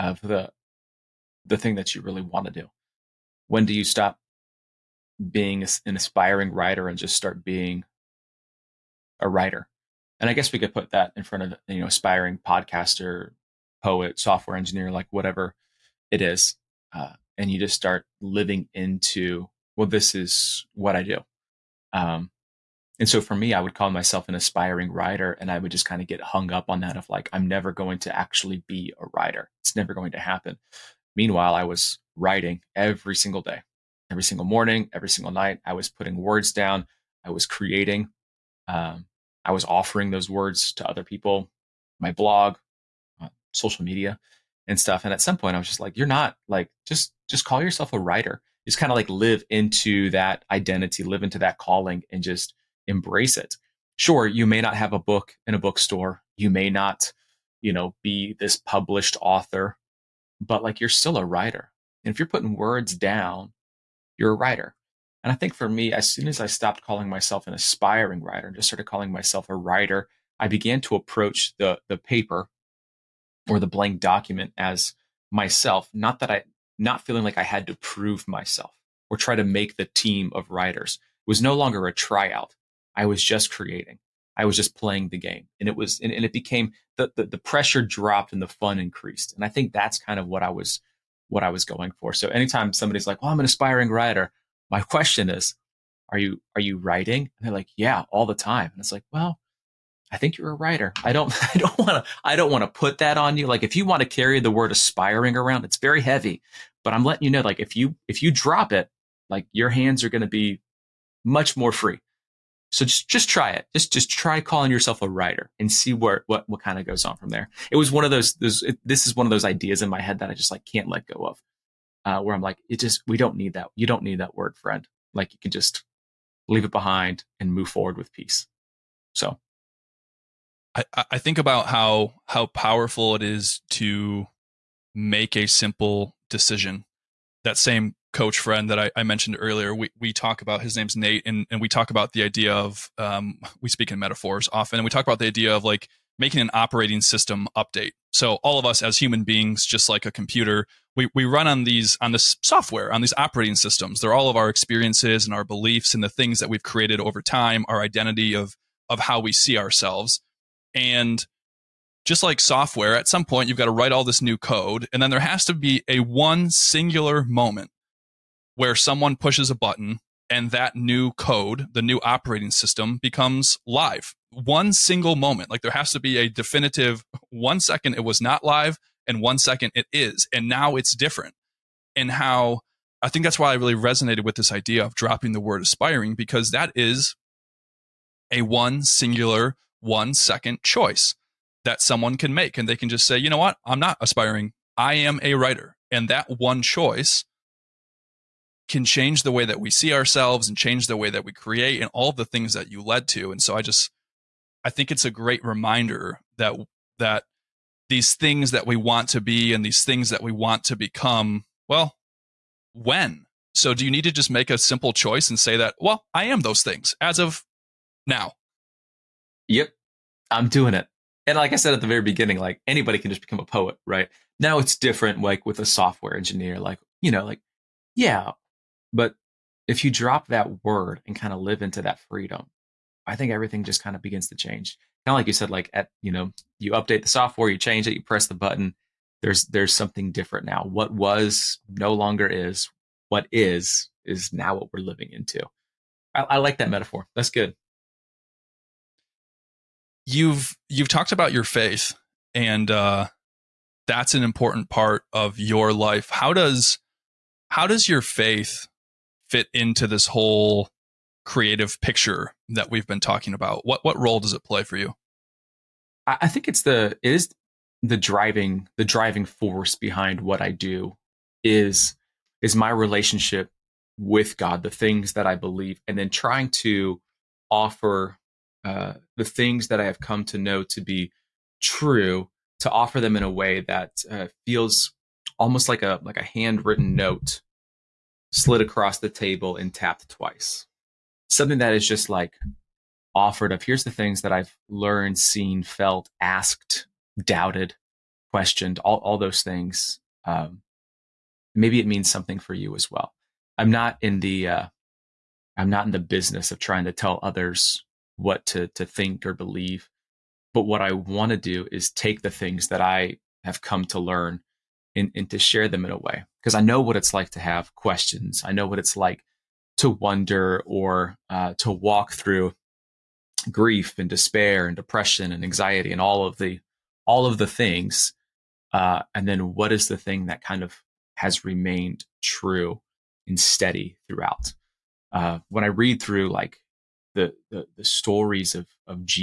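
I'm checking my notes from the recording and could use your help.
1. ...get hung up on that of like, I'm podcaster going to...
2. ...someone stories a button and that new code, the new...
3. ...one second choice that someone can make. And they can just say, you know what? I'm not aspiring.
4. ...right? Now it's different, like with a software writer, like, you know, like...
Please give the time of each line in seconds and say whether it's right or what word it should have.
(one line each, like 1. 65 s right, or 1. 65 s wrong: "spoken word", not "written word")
1. 26 s wrong: "never", not "podcaster"
2. 168 s wrong: "pushes", not "stories"
3. 189 s right
4. 223 s wrong: "engineer", not "writer".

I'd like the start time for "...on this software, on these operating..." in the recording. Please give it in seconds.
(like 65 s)
151 s.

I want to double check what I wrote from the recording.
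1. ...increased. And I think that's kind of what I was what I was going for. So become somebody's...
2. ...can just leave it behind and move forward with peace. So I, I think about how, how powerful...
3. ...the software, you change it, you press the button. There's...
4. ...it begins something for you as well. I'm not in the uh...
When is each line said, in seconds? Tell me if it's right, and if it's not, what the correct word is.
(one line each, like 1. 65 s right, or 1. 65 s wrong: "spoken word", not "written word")
1. 88 s wrong: "anytime", not "become"
2. 125 s right
3. 237 s right
4. 301 s wrong: "means", not "begins".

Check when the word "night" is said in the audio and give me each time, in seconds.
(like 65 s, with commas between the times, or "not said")
35 s.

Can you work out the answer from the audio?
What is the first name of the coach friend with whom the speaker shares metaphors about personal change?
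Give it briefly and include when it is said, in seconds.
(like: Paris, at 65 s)
Nate, at 140 s.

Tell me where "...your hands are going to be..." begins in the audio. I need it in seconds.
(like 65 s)
109 s.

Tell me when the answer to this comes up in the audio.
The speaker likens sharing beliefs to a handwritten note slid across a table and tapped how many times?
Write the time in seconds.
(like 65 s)
289 s.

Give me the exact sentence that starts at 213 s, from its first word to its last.
So do you need to just make a simple choice and say that, well, I am those things as of now?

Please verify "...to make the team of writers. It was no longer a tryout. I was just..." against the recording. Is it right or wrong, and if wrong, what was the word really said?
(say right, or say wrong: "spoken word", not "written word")
right.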